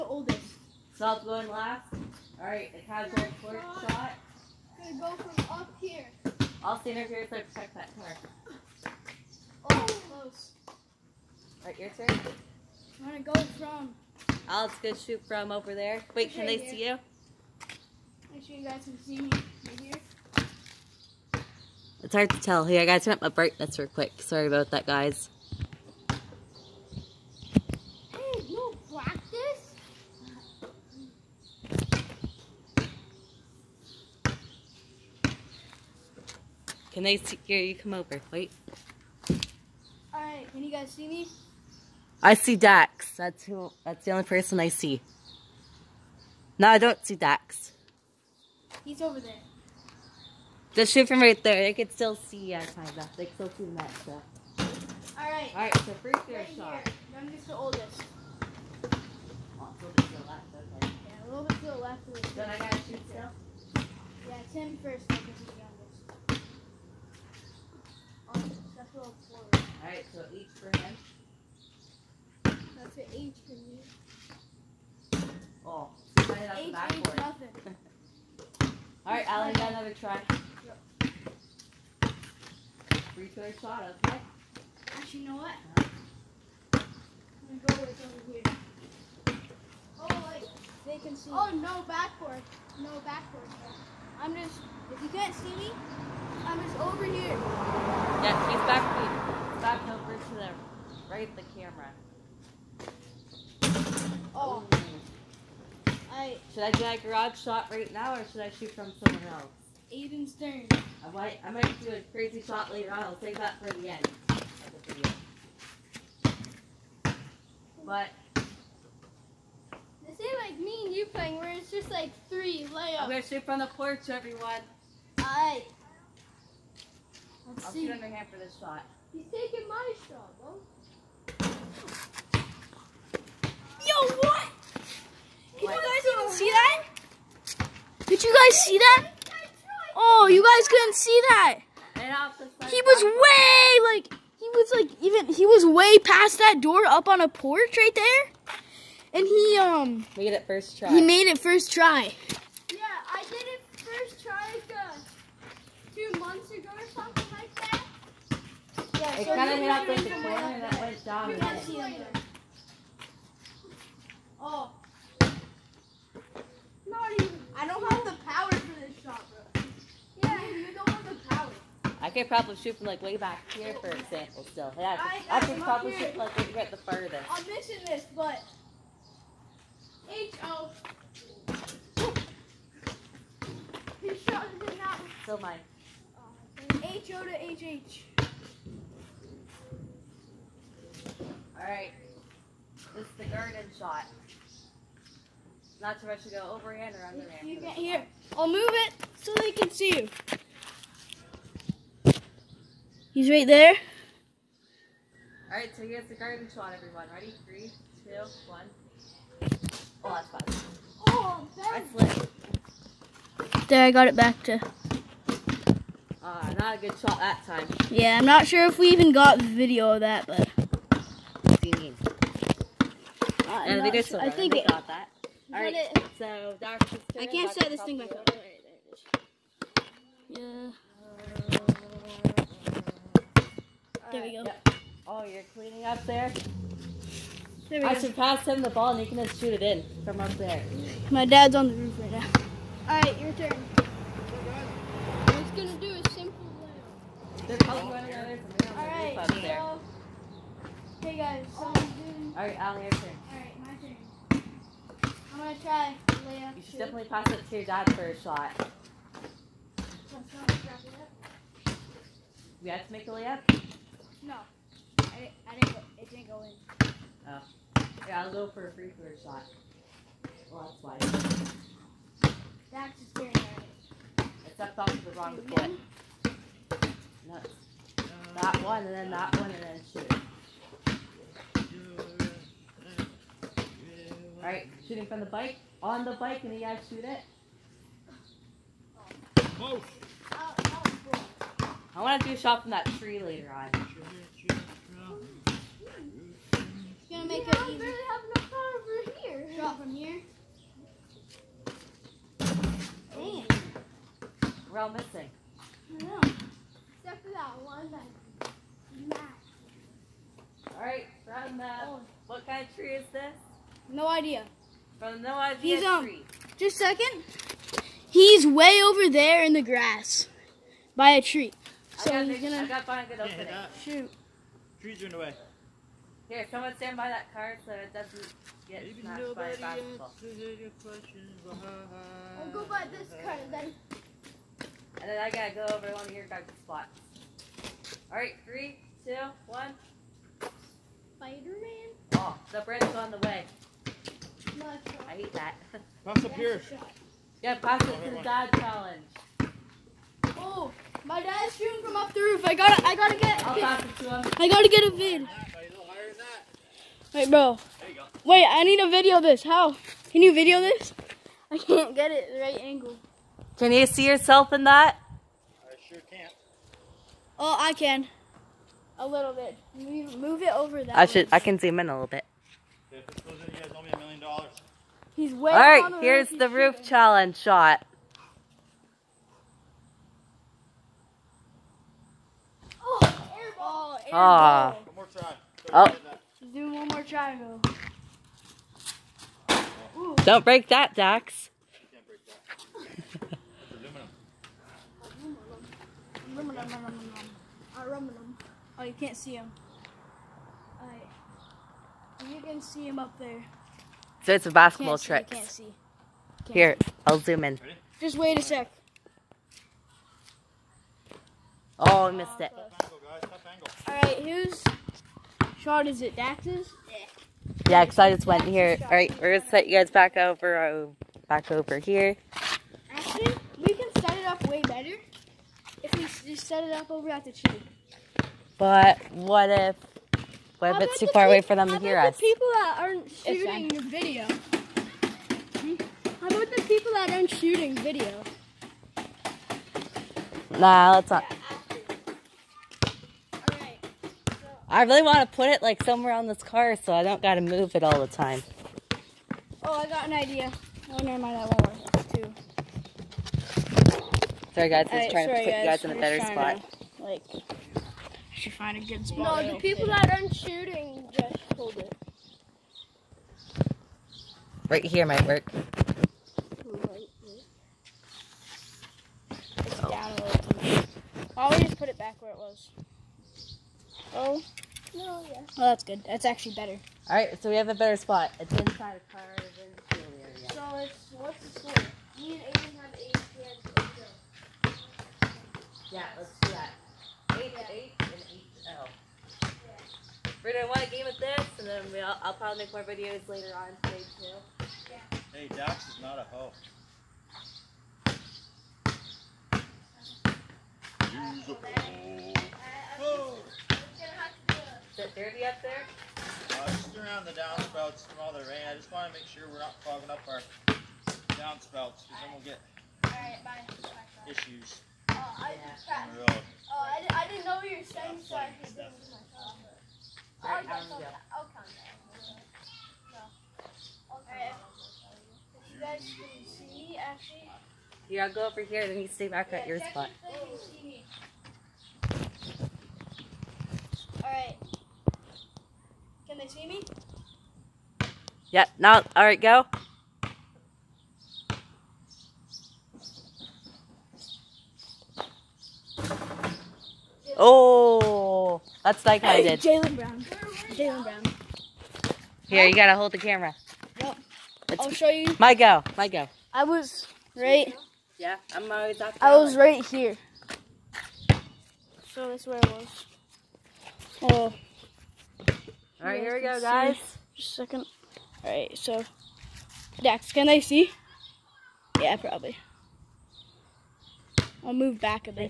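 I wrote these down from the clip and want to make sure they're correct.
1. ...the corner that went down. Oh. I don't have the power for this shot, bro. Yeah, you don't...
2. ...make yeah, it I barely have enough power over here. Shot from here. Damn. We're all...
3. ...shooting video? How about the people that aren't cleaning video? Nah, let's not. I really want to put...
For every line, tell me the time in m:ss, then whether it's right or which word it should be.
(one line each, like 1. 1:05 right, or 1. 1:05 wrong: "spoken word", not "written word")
1. 2:39 right
2. 4:57 right
3. 7:13 wrong: "shooting", not "cleaning".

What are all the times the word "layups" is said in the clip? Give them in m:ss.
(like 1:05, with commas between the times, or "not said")
2:02, 4:23.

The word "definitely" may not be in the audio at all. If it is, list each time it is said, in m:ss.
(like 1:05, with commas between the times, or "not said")
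4:16.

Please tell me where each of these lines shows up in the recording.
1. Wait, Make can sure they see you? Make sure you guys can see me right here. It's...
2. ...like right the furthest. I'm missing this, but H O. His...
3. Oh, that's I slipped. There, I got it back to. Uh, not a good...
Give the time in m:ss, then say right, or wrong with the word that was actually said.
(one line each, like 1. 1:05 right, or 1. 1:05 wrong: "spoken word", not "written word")
1. 0:16 right
2. 2:56 right
3. 3:31 right.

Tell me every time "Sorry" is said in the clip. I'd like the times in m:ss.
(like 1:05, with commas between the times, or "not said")
0:24, 7:34.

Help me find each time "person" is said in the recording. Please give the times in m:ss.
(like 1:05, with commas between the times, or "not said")
0:44.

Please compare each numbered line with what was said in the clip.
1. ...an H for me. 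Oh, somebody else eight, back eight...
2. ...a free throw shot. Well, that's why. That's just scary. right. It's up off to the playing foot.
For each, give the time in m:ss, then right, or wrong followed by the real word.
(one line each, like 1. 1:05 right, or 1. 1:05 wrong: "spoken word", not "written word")
1. 1:12 right
2. 4:28 wrong: "wrong", not "playing".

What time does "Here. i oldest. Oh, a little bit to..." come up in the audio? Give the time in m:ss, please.
0:56.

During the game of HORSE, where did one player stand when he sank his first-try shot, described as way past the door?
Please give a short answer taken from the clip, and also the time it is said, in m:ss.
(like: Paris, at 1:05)
On a porch, at 2:26.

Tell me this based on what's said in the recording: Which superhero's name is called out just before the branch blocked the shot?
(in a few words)
Spider-Man.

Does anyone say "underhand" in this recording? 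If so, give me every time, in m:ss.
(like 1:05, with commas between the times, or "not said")
2:07, 3:17.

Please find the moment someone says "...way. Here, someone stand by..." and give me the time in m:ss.
5:25.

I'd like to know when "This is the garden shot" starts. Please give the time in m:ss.
3:12.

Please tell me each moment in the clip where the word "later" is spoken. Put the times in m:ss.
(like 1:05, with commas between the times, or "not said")
1:52, 4:53, 8:13.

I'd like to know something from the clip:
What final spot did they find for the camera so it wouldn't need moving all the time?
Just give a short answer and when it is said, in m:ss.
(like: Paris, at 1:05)
Inside a car, at 7:58.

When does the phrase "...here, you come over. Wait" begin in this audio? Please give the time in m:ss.
0:37.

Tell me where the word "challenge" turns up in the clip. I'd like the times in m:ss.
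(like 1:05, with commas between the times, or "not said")
5:48, 6:16.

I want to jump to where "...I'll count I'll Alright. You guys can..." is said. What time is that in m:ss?
8:40.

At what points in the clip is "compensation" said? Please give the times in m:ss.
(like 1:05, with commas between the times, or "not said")
not said.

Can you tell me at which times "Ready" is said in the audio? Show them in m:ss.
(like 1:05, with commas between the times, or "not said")
3:27, 6:47.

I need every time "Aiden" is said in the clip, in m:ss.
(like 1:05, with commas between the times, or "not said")
1:49, 8:02.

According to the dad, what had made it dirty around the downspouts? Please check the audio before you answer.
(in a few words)
Rain.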